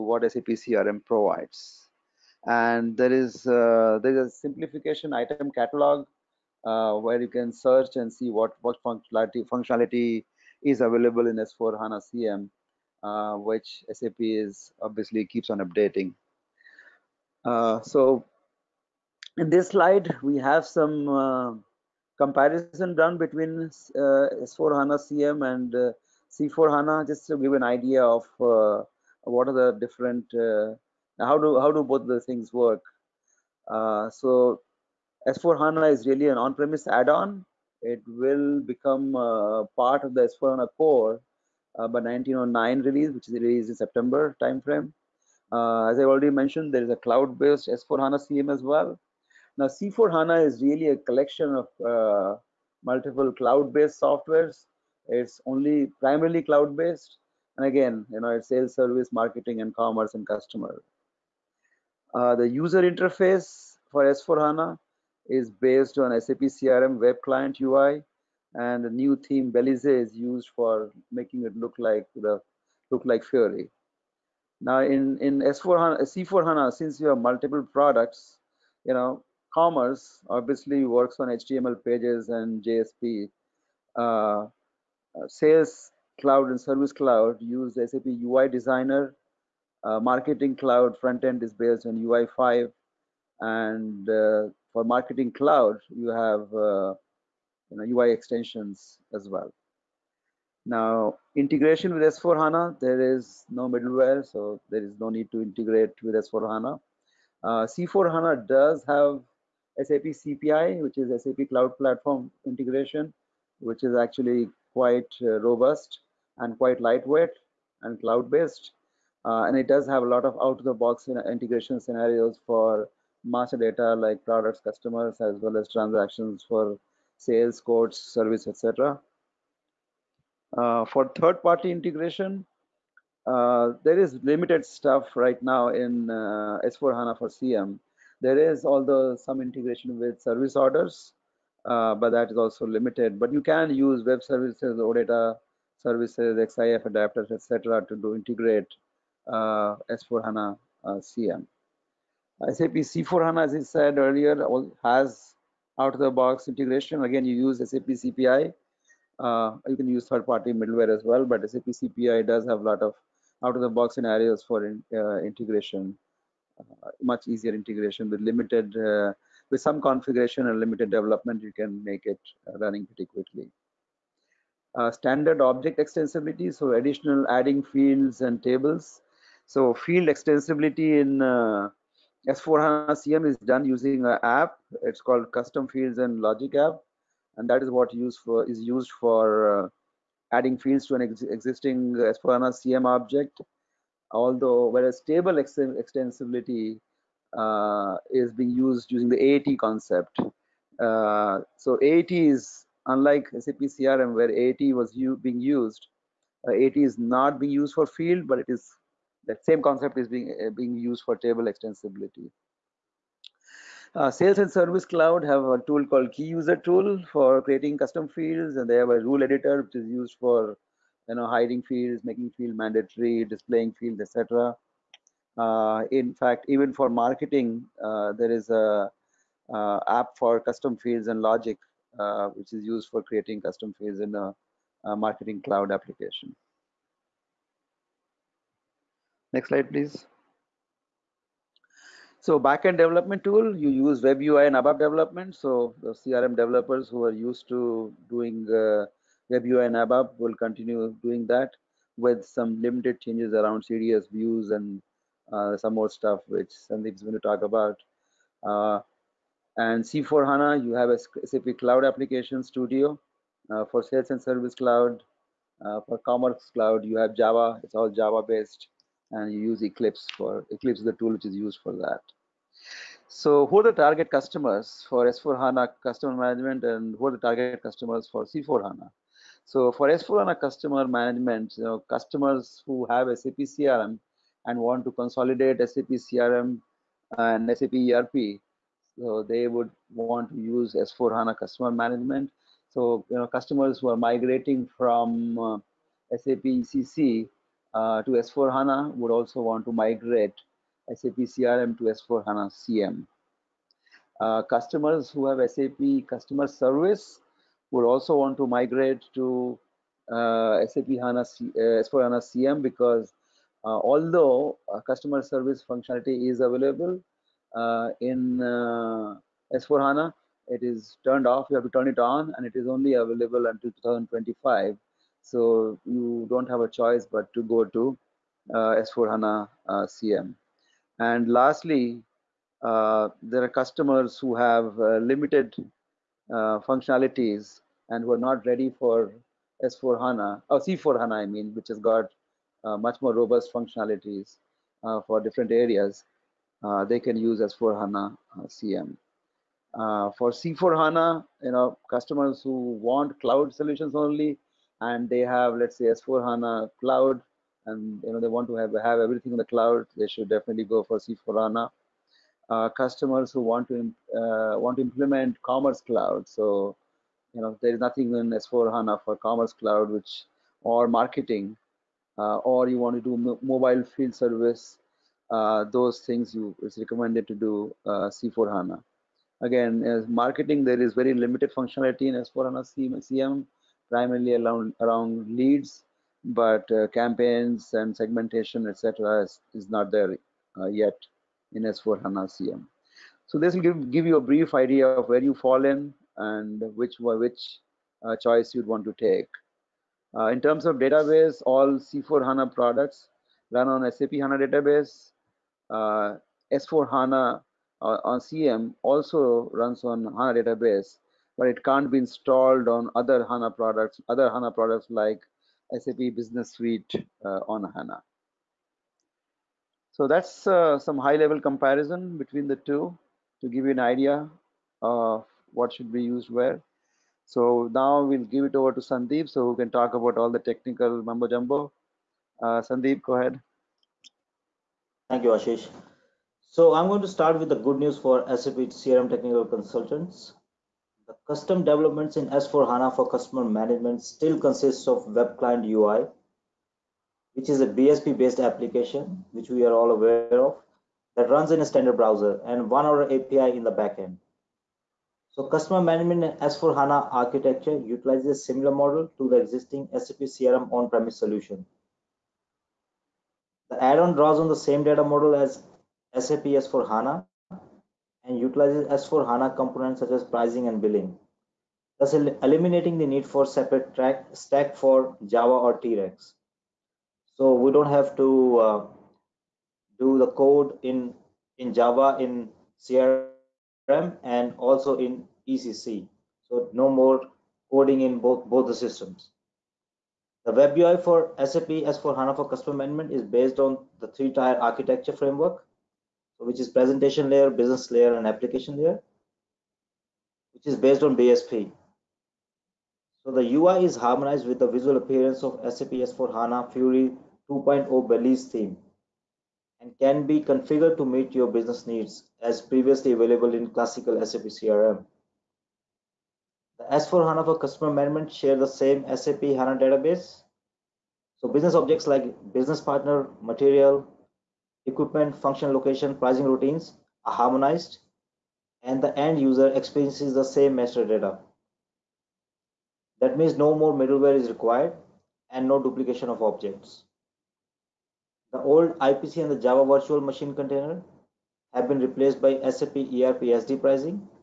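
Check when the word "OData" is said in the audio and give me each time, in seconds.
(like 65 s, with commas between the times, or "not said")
144 s.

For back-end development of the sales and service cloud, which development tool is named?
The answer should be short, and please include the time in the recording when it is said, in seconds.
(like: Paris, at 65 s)
SAP Cloud Application Studio, at 261 s.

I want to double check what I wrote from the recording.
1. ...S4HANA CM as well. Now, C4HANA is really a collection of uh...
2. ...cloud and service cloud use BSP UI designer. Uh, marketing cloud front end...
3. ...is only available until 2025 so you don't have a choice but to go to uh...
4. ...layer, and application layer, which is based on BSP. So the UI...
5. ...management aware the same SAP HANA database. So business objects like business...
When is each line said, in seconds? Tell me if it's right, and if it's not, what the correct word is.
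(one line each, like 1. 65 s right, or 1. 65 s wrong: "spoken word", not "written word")
1. 47 s right
2. 86 s wrong: "SAP", not "BSP"
3. 322 s right
4. 497 s right
5. 517 s wrong: "share", not "aware".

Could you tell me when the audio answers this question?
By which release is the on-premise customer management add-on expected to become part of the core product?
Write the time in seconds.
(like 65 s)
41 s.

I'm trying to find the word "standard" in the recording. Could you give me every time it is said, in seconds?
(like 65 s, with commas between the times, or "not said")
174 s, 451 s.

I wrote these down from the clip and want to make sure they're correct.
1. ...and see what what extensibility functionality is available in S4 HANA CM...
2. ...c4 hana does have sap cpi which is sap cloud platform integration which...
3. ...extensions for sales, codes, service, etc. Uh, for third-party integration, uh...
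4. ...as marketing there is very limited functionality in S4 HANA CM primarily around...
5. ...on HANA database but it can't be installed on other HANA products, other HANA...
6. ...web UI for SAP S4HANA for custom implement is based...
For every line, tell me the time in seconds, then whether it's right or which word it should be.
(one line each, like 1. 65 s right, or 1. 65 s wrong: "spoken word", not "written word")
1. 7 s wrong: "functionality", not "extensibility"
2. 107 s right
3. 125 s wrong: "transactions", not "extensions"
4. 379 s right
5. 409 s right
6. 490 s wrong: "management", not "implement".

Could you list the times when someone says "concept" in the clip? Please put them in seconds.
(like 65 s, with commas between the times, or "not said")
199 s, 209 s.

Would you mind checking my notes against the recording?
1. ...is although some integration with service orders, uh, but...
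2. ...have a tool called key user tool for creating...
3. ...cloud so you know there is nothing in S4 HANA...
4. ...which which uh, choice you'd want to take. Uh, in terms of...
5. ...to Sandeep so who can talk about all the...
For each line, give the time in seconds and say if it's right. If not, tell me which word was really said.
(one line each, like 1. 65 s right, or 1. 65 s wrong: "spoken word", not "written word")
1. 138 s right
2. 215 s right
3. 365 s right
4. 396 s right
5. 428 s right.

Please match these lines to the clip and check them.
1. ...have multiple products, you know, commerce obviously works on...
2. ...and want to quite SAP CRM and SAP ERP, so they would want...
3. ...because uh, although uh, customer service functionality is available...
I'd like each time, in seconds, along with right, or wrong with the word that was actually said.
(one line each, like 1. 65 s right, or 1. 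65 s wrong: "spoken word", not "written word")
1. 77 s right
2. 284 s wrong: "consolidate", not "quite"
3. 312 s right.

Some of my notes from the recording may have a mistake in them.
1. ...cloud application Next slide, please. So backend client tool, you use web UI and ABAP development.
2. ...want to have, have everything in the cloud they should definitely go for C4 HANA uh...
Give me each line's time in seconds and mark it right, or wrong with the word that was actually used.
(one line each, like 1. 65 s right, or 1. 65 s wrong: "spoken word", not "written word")
1. 235 s wrong: "development", not "client"
2. 358 s right.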